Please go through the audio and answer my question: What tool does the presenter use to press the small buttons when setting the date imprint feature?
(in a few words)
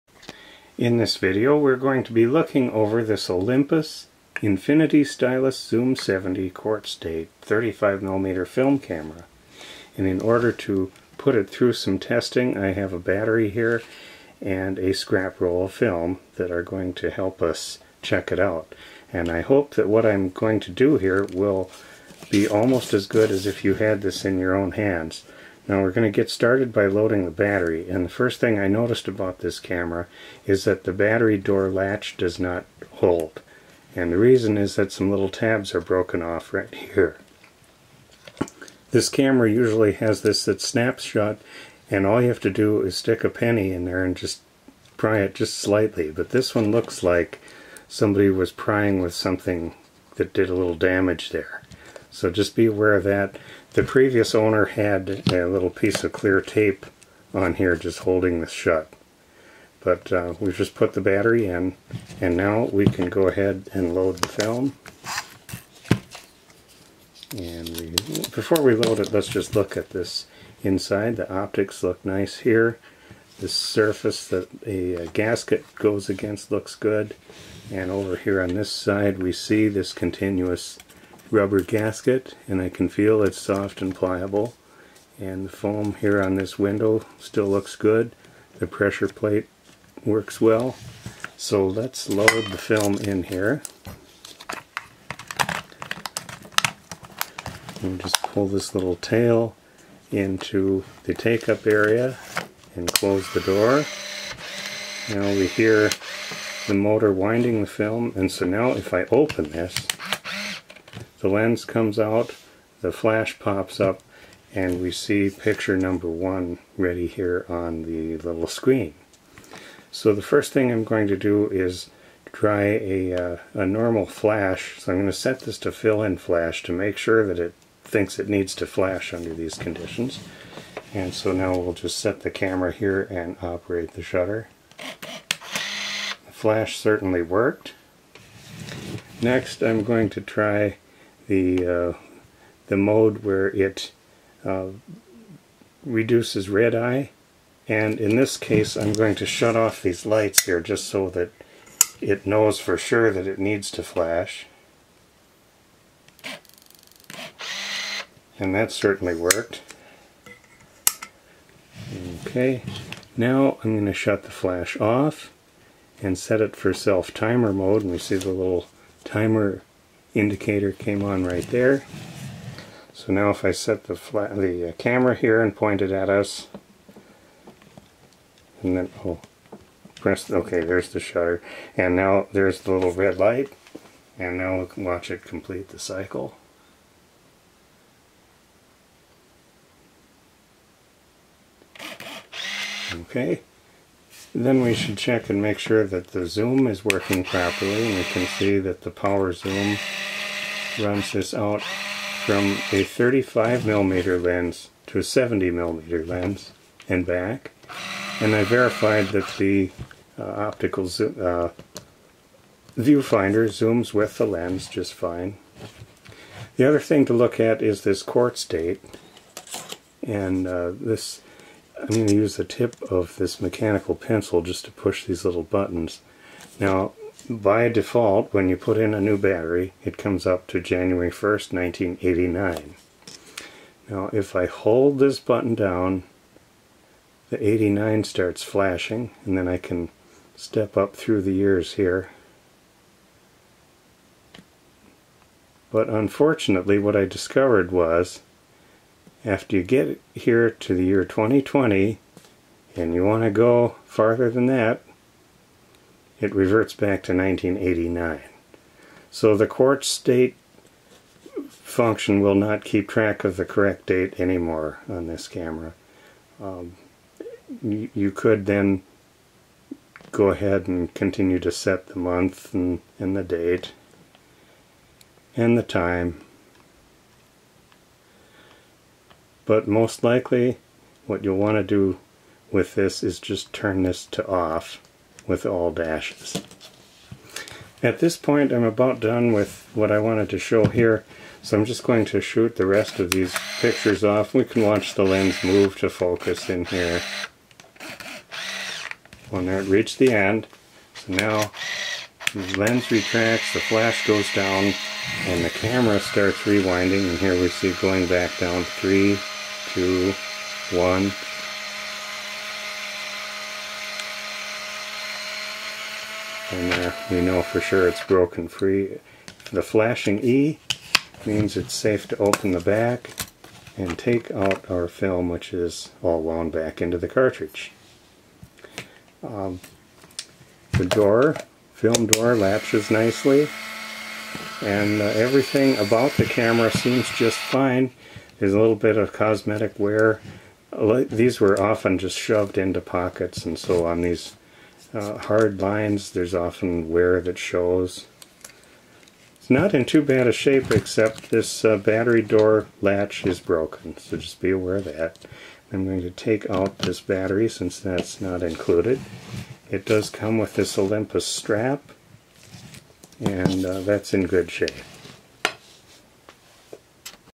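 mechanical pencil.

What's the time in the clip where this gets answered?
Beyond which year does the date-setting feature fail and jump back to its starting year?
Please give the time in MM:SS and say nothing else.
04:11.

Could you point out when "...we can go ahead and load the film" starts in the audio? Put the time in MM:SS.
01:02.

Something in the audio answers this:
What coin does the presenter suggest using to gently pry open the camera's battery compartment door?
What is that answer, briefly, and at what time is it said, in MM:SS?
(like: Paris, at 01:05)
penny, at 00:43.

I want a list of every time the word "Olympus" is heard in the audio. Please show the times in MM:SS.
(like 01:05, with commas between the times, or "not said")
00:03, 06:00.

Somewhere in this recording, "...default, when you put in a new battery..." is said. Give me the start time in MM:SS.
03:47.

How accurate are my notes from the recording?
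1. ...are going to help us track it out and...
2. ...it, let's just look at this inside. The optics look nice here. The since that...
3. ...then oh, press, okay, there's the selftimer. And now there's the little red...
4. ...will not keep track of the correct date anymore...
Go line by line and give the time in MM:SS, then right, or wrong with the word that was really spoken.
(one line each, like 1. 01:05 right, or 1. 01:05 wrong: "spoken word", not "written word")
1. 00:16 wrong: "check", not "track"
2. 01:08 wrong: "surface", not "since"
3. 02:58 wrong: "shutter", not "selftimer"
4. 04:22 right.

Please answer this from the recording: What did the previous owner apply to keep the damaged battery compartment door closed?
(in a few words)
clear tape.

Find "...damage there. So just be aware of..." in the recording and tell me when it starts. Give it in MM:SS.
00:50.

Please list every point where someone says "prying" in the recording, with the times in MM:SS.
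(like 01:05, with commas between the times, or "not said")
00:48.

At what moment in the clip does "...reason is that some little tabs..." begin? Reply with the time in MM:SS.
00:34.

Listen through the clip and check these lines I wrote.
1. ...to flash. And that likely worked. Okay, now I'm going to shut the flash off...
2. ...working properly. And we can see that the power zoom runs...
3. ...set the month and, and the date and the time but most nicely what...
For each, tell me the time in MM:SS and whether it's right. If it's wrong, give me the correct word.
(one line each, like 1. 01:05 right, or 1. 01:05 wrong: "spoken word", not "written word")
1. 02:33 wrong: "certainly", not "likely"
2. 03:16 right
3. 04:31 wrong: "likely", not "nicely".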